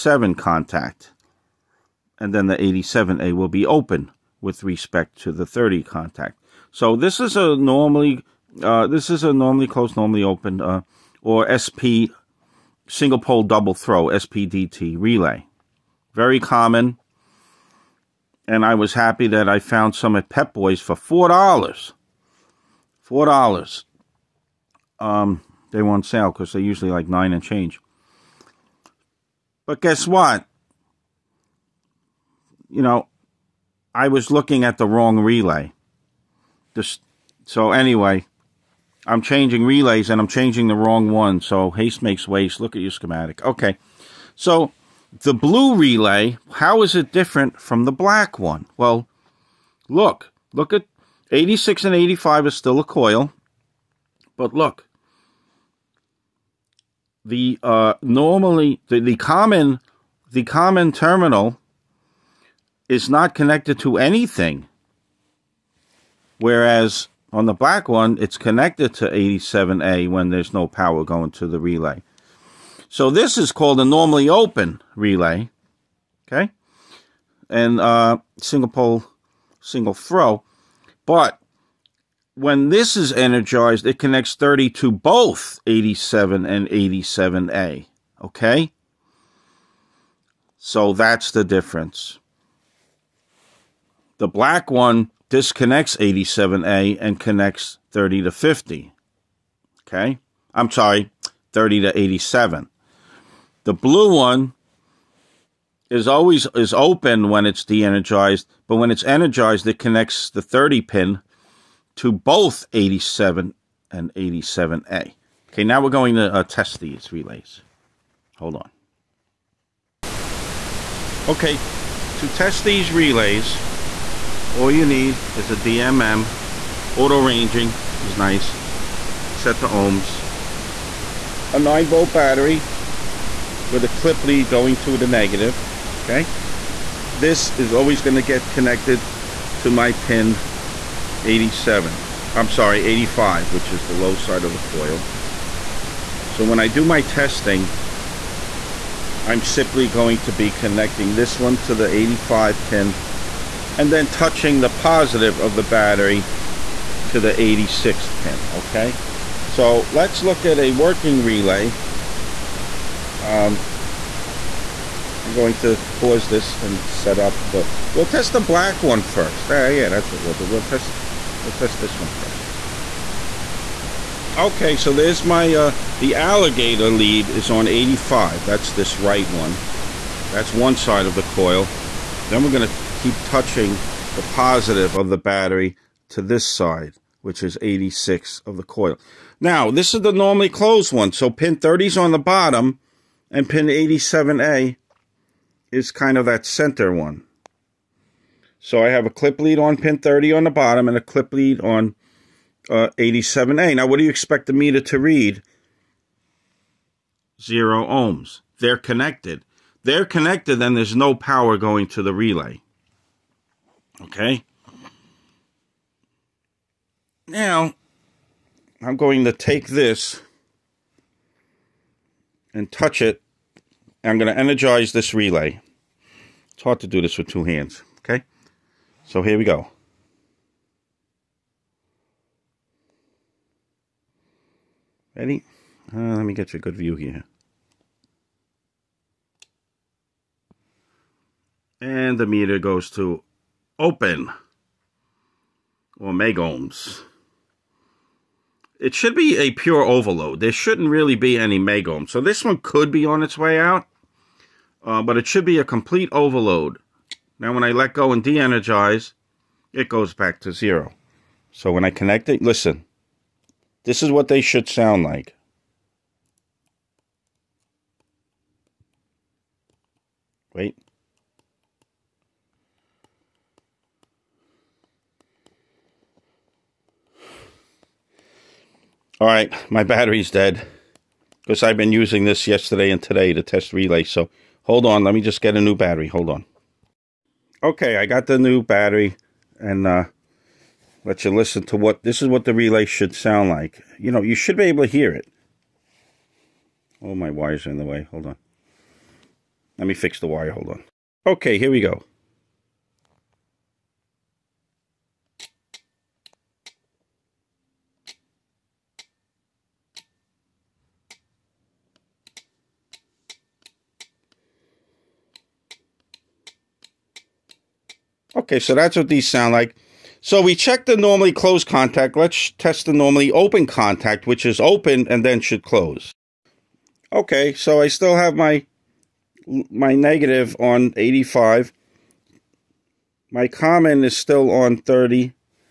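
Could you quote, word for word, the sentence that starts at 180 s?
That's one side of the coil.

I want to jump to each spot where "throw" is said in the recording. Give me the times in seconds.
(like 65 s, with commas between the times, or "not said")
13 s, 79 s.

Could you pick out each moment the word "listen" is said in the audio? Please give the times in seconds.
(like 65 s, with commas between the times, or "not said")
262 s, 291 s.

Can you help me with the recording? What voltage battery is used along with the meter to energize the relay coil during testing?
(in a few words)
9 volt.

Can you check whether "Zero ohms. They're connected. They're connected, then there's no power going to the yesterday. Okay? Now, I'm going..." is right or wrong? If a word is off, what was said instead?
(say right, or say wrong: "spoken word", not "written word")
wrong: "relay", not "yesterday".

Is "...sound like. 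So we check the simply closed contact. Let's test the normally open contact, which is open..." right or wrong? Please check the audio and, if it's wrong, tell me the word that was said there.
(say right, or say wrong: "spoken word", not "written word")
wrong: "normally", not "simply".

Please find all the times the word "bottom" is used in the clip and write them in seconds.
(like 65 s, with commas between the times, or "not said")
192 s, 200 s.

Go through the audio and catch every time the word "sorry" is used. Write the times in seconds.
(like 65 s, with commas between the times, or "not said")
100 s, 142 s.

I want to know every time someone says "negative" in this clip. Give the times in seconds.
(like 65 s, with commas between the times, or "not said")
135 s, 329 s.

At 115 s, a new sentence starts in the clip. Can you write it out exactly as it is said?
Okay, now we're going to uh, test these relays.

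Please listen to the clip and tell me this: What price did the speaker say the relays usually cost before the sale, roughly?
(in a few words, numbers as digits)
9 dollars.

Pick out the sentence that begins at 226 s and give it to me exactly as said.
It's hard to do this with two hands, okay?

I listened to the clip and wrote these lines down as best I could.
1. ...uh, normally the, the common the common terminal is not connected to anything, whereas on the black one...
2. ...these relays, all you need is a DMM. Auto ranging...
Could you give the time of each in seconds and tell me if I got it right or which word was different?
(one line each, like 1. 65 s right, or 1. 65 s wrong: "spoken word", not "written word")
1. 57 s right
2. 122 s right.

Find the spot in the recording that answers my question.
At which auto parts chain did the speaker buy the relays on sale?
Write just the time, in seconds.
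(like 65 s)
20 s.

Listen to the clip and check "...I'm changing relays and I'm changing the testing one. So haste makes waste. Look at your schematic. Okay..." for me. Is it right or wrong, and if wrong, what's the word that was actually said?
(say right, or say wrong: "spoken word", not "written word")
wrong: "wrong", not "testing".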